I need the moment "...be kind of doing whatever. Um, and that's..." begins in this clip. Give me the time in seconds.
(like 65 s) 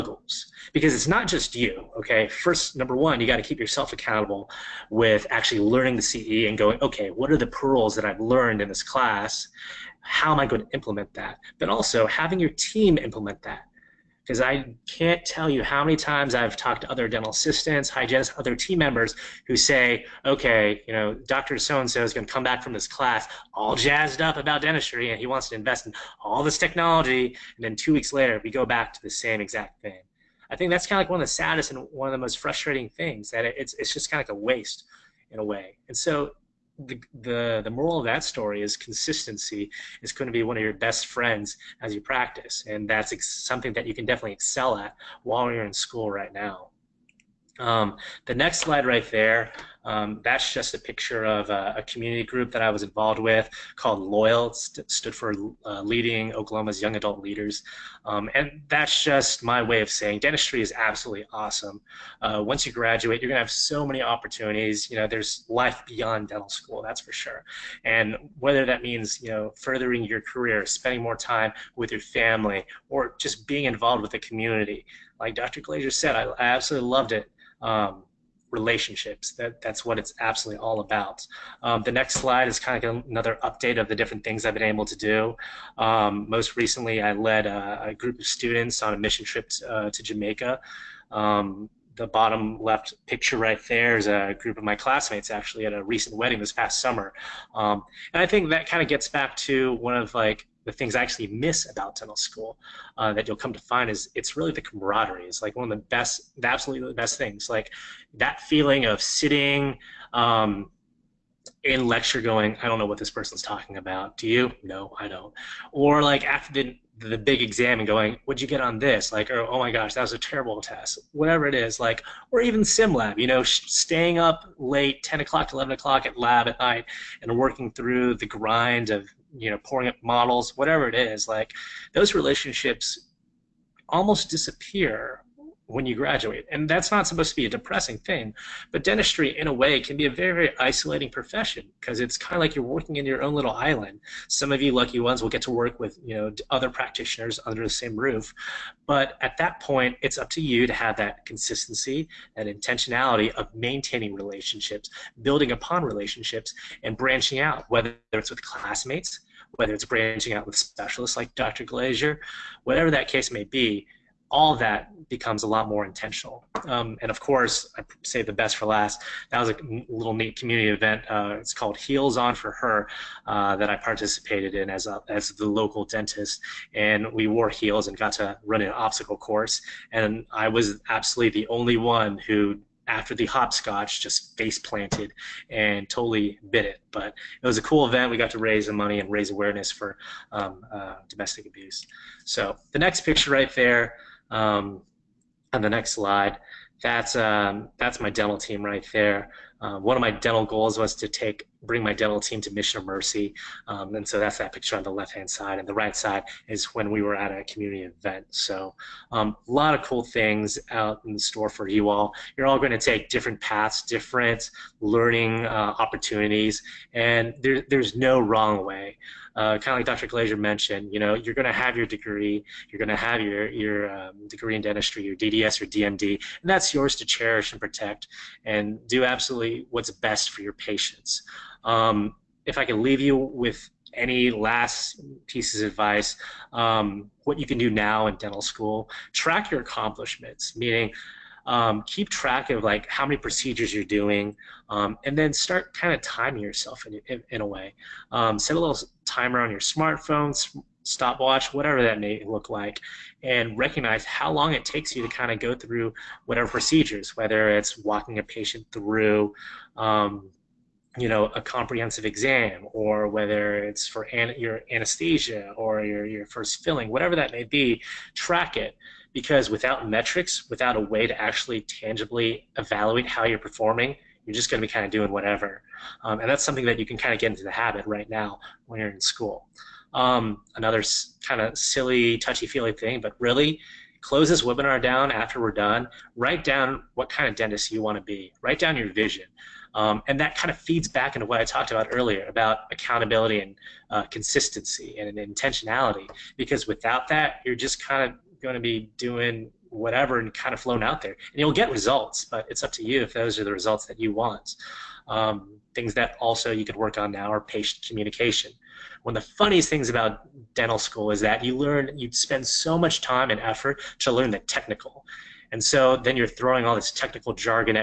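274 s.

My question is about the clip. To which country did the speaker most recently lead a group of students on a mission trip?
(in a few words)
Jamaica.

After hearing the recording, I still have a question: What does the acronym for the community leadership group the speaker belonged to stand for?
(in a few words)
Leading Oklahoma's Young Adult Leaders.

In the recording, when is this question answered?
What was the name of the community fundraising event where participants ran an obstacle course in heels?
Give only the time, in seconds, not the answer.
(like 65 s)
171 s.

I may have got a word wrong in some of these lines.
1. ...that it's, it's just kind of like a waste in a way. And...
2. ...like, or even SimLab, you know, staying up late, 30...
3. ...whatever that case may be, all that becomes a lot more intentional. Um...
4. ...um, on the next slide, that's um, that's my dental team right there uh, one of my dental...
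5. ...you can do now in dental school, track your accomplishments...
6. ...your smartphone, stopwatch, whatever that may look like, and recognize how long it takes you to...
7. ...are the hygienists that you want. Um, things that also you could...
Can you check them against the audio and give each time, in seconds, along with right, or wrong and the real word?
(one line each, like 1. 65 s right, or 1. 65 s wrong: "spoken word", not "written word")
1. 33 s right
2. 121 s wrong: "10", not "30"
3. 162 s right
4. 194 s right
5. 237 s right
6. 249 s right
7. 303 s wrong: "results", not "hygienists".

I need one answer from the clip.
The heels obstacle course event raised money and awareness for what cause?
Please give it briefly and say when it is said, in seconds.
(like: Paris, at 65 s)
domestic abuse, at 191 s.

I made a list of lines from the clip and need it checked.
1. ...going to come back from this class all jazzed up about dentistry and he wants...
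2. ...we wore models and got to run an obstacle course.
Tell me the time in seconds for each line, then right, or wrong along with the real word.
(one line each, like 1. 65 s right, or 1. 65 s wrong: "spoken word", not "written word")
1. 22 s right
2. 177 s wrong: "heels", not "models".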